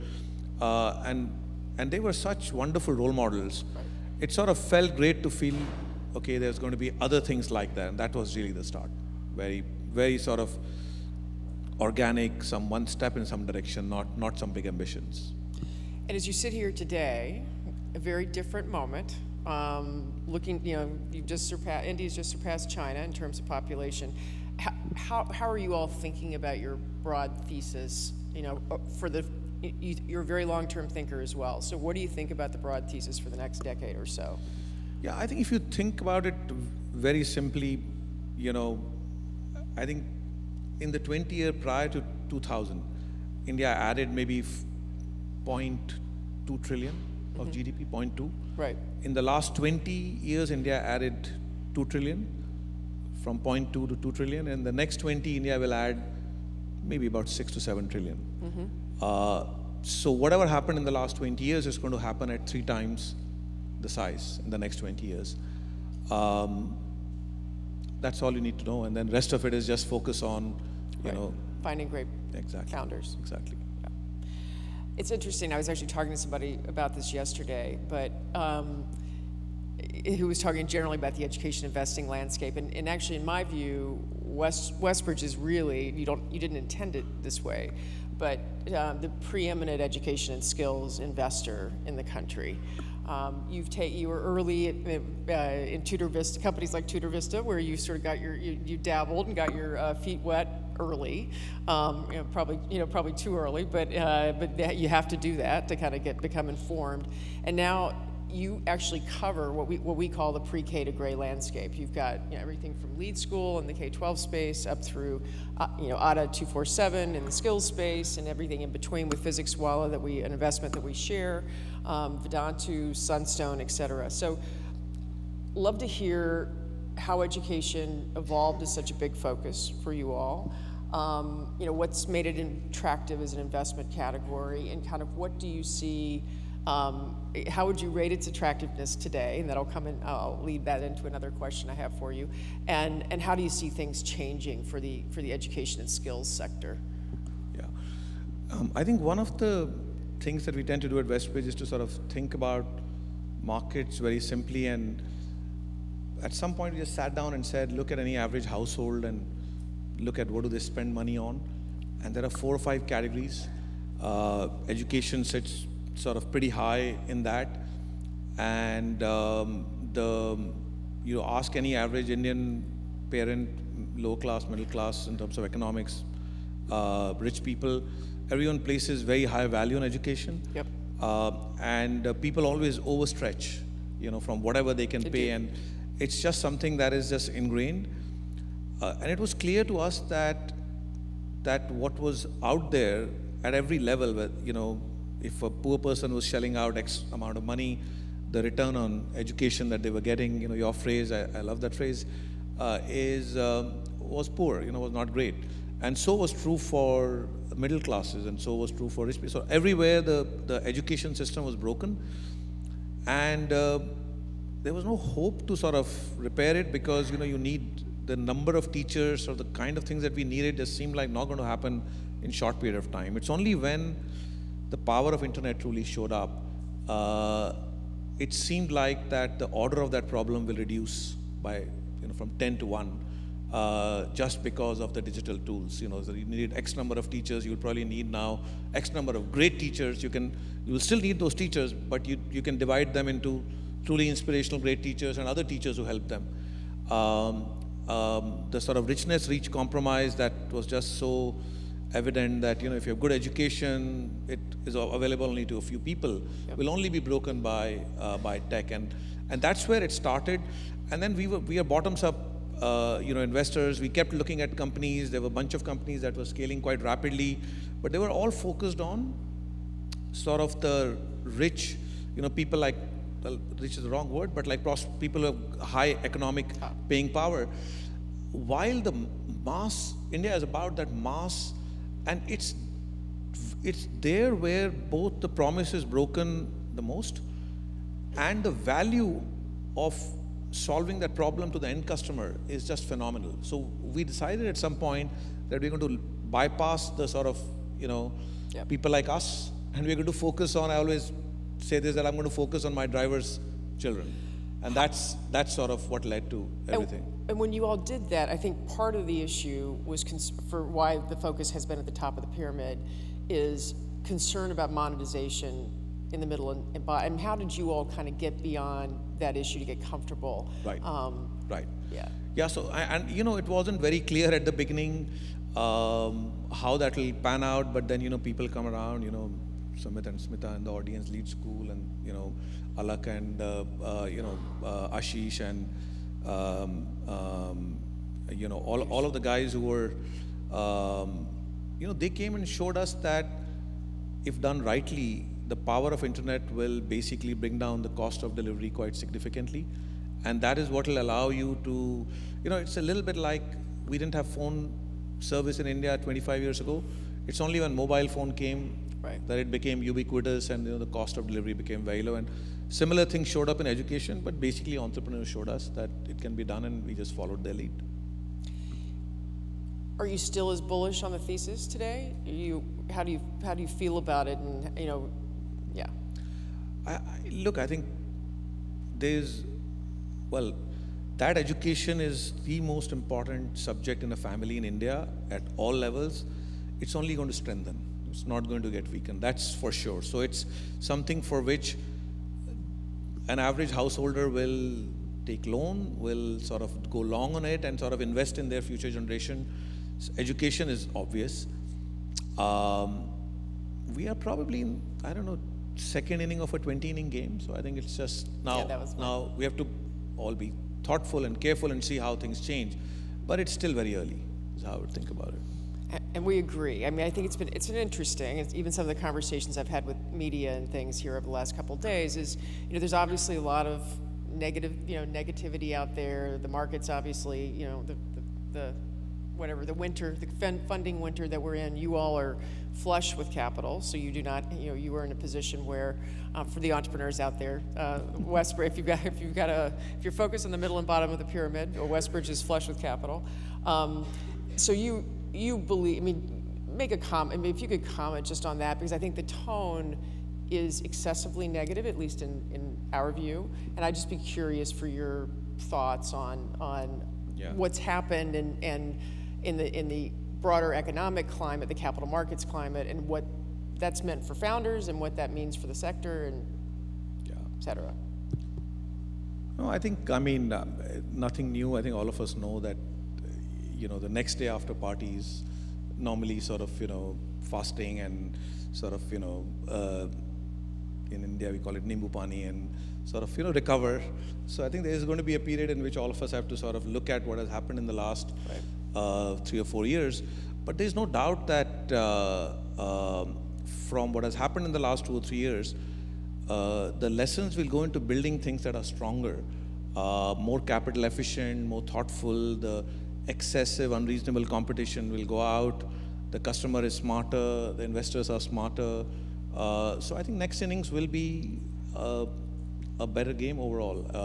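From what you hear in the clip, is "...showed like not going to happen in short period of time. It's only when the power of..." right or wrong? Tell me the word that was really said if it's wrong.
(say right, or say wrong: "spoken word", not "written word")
wrong: "seemed", not "showed".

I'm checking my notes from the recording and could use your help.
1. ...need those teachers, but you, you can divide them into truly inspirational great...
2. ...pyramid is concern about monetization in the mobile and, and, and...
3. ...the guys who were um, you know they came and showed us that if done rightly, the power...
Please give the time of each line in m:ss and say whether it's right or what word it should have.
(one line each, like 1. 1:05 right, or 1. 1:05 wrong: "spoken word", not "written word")
1. 4:01 right
2. 5:12 wrong: "middle", not "mobile"
3. 5:39 right.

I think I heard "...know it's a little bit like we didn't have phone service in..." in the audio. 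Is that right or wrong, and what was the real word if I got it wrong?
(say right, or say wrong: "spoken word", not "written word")
right.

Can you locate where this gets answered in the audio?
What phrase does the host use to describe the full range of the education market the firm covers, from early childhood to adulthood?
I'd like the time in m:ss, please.
1:50.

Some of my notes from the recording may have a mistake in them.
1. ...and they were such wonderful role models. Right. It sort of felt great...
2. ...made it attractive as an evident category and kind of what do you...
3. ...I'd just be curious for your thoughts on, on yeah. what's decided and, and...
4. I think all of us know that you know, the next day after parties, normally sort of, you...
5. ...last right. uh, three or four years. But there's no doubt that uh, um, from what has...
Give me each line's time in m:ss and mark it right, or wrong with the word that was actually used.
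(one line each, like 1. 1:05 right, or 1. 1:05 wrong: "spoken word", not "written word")
1. 0:01 right
2. 2:12 wrong: "investment", not "evident"
3. 7:33 wrong: "happened", not "decided"
4. 7:51 right
5. 8:07 right.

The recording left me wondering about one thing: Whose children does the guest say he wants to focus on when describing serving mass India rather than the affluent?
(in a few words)
my driver's children.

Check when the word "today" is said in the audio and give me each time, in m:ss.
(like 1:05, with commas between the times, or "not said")
0:16, 2:18, 6:11.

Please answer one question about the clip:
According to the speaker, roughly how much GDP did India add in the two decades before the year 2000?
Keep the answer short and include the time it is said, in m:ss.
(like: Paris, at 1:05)
0.2 trillion, at 0:44.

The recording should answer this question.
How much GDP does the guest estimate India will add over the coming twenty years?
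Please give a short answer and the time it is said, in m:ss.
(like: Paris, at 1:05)
6 to 7 trillion, at 0:57.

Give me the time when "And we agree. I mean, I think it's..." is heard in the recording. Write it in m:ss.
6:56.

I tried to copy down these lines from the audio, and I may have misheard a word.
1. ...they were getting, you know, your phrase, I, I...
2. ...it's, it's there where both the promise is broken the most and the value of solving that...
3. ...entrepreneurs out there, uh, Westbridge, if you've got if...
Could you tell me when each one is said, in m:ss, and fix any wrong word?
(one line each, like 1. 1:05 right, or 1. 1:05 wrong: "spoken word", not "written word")
1. 3:19 right
2. 4:42 right
3. 7:16 right.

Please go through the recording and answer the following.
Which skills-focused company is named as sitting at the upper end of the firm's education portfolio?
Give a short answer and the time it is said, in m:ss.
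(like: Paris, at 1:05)
Adda 247, at 1:55.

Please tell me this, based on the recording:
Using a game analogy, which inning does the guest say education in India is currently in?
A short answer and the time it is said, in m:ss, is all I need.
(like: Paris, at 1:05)
second inning, at 6:45.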